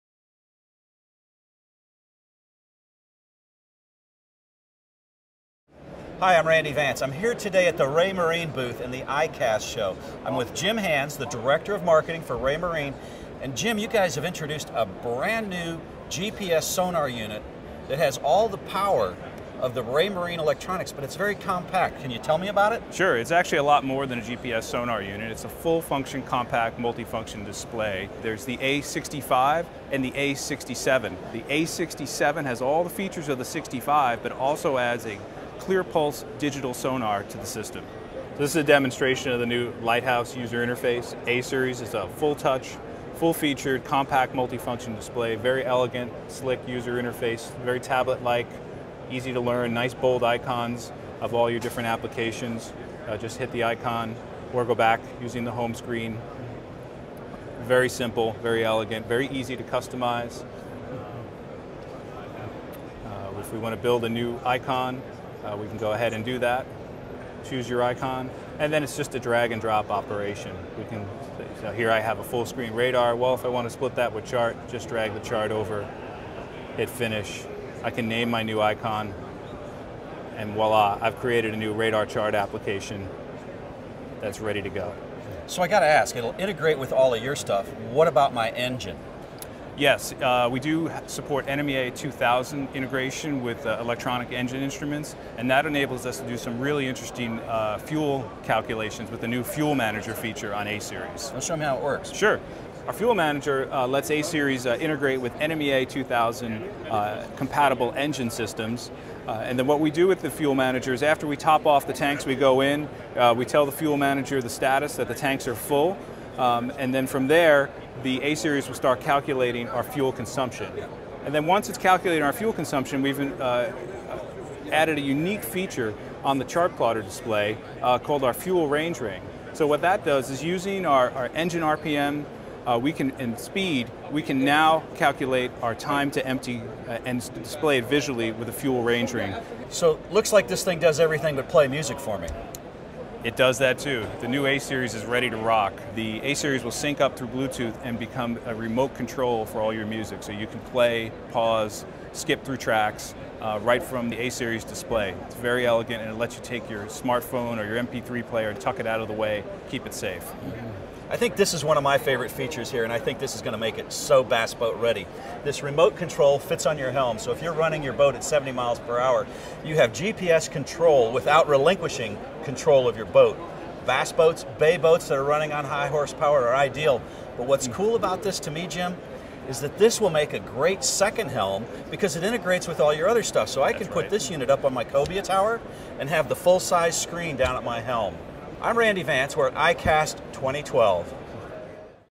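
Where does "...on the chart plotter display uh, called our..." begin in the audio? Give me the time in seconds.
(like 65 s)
126 s.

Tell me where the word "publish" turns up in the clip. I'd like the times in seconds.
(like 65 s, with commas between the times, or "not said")
not said.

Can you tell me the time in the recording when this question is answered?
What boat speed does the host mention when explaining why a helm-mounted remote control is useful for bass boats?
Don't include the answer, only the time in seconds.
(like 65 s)
168 s.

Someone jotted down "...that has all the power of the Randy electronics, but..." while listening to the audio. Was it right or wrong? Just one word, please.
wrong.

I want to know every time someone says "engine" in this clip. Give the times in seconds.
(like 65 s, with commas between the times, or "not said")
88 s, 94 s, 107 s, 131 s.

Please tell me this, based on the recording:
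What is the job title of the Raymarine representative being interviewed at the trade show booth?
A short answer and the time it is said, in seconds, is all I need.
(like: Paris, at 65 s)
Director of Marketing, at 11 s.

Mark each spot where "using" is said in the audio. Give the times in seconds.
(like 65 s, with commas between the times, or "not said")
55 s, 130 s.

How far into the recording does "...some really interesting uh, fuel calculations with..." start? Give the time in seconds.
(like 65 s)
96 s.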